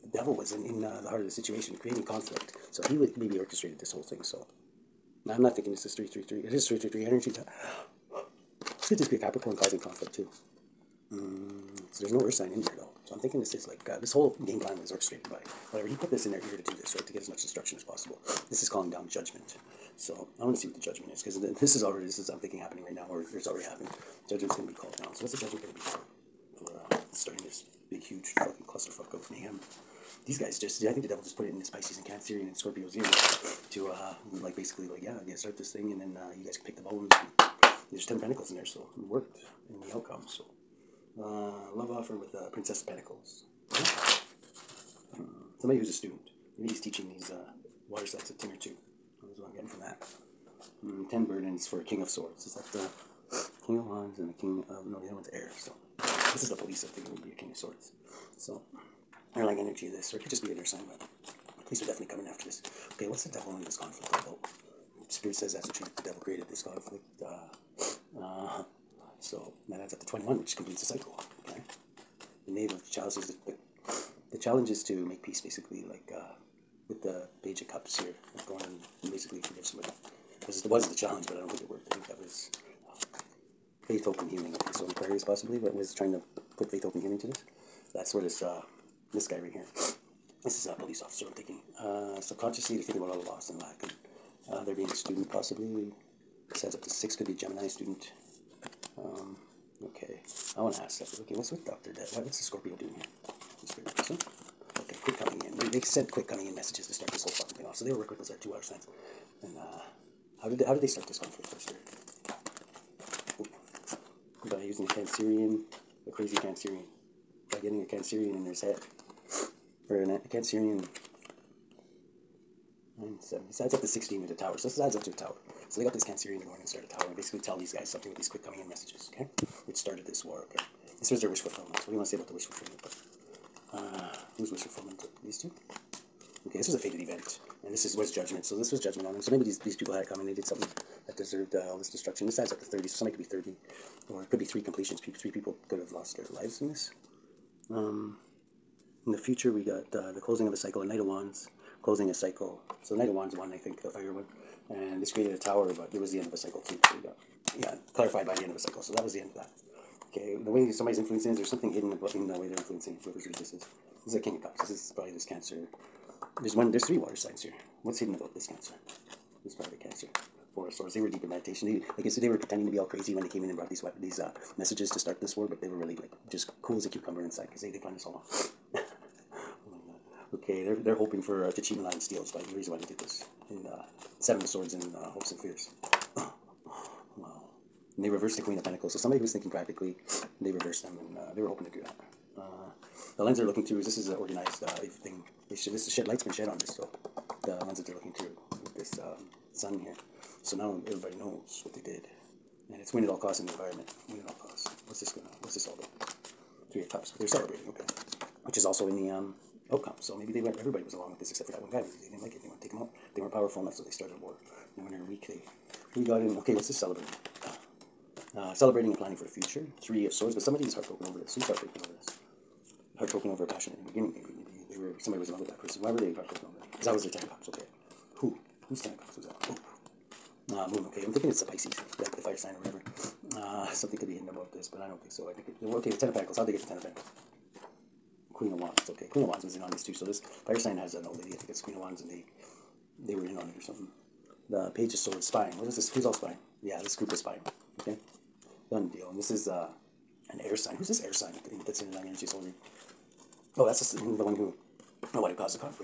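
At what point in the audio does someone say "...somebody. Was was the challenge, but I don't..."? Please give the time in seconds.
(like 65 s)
79 s.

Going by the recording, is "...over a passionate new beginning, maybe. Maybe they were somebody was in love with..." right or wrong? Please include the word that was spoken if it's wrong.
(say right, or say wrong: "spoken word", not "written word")
right.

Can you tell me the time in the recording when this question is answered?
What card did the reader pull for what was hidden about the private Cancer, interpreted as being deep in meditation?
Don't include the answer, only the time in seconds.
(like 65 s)
170 s.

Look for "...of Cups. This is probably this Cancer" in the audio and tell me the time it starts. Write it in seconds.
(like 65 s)
164 s.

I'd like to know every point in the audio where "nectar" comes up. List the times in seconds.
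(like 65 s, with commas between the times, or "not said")
not said.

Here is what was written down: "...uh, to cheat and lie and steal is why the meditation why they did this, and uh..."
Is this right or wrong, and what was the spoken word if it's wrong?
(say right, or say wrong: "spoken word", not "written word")
wrong: "reason", not "meditation".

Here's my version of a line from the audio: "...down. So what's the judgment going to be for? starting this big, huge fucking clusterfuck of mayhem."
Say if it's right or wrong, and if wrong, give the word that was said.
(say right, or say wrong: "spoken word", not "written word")
right.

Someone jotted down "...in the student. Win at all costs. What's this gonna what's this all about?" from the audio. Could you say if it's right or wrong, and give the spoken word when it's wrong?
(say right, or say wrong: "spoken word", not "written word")
wrong: "environment", not "student".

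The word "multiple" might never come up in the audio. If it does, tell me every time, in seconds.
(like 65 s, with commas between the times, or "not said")
not said.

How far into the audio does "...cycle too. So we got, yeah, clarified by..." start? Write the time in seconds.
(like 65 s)
156 s.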